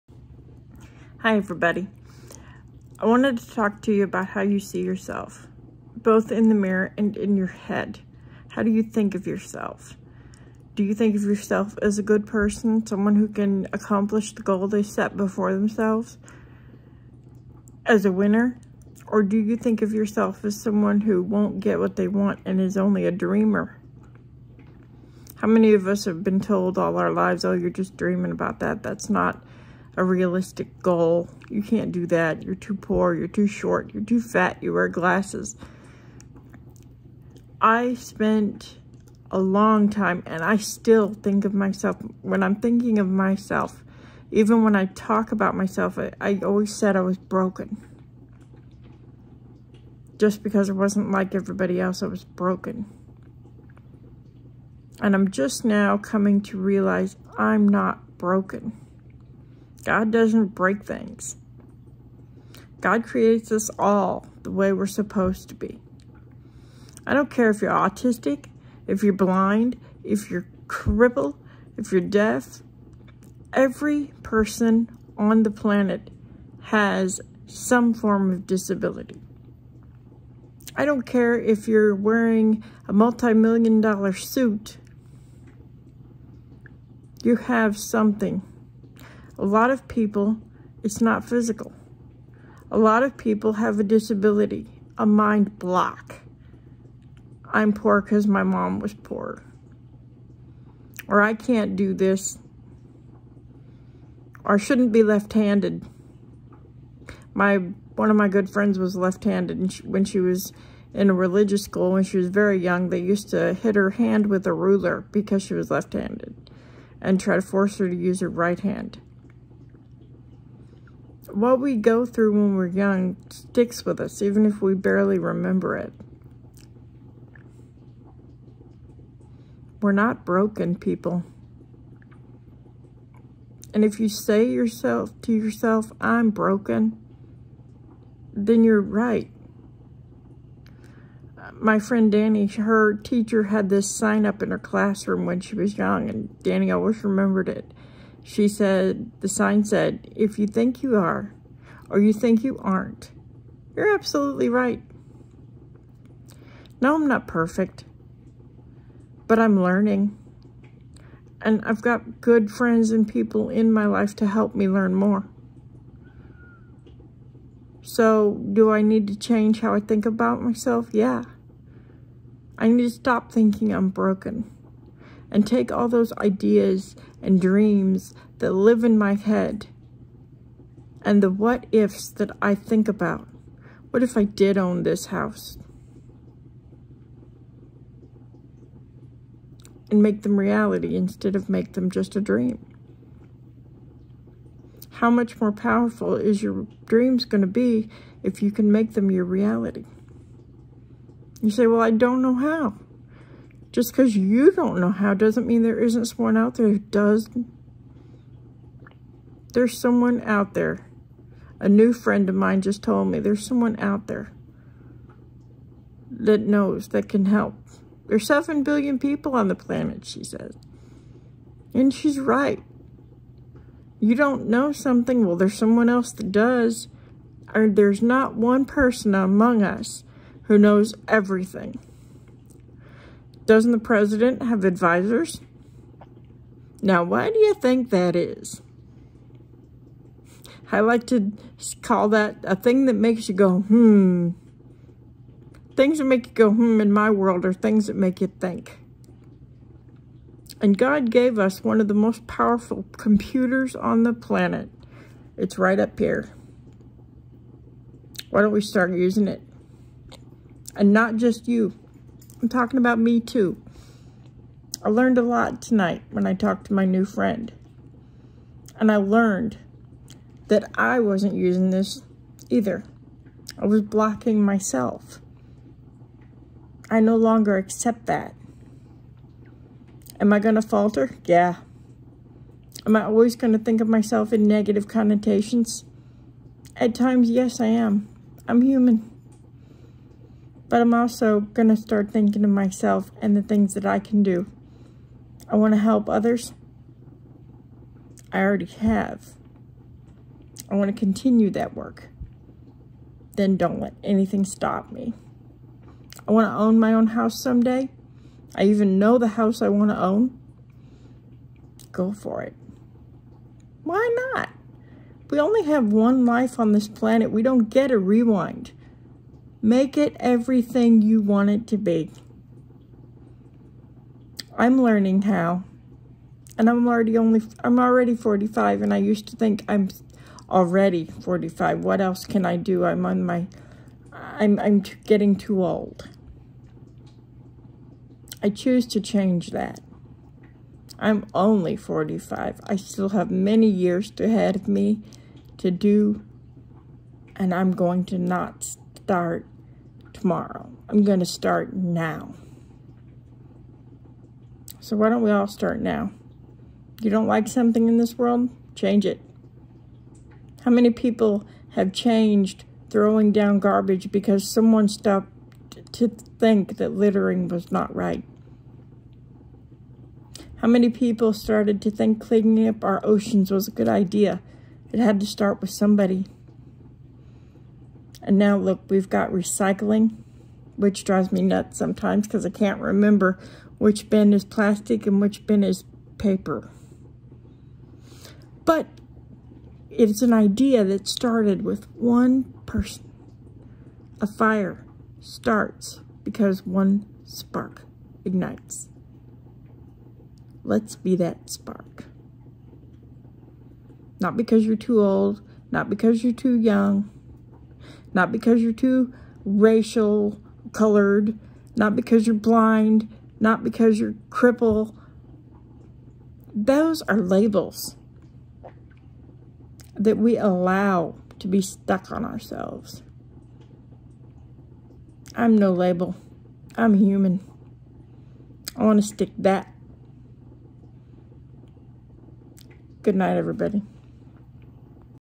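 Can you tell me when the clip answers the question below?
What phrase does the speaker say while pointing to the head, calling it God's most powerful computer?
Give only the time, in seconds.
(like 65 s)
245 s.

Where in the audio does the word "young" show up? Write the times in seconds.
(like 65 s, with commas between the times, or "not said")
112 s, 122 s, 145 s, 406 s.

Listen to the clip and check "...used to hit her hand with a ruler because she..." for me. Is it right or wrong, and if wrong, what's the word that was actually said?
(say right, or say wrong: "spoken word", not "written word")
right.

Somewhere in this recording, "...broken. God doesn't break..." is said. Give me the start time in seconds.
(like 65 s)
58 s.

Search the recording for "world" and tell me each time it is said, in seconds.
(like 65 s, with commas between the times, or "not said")
247 s, 358 s.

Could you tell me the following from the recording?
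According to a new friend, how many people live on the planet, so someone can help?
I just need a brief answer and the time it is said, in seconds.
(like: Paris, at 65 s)
7 billion, at 218 s.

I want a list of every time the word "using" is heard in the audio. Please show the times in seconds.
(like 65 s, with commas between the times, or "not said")
258 s, 271 s.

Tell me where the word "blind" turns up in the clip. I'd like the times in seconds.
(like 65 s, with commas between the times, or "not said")
69 s, 412 s.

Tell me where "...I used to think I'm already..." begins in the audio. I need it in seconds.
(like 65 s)
328 s.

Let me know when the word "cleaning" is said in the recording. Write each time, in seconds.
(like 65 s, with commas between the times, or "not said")
372 s.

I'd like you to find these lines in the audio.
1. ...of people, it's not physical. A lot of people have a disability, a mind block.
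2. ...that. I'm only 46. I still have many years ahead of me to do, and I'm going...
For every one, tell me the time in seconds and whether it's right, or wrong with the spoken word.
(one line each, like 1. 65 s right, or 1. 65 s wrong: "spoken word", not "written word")
1. 89 s right
2. 339 s wrong: "45", not "46".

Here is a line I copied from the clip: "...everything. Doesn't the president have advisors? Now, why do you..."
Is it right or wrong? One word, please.
right.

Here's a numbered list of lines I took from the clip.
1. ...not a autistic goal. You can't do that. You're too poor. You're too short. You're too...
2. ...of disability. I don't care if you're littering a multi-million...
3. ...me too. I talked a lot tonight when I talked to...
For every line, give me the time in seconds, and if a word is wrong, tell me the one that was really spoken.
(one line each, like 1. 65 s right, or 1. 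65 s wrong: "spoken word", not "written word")
1. 29 s wrong: "realistic", not "autistic"
2. 78 s wrong: "wearing", not "littering"
3. 262 s wrong: "learned", not "talked".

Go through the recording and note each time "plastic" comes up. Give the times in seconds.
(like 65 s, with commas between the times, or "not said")
384 s.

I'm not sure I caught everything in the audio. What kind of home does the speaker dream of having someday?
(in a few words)
own house.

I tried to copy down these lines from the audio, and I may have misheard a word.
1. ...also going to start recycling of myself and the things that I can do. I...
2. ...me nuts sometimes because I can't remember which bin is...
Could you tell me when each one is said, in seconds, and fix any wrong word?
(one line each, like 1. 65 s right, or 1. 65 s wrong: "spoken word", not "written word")
1. 290 s wrong: "thinking", not "recycling"
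2. 381 s right.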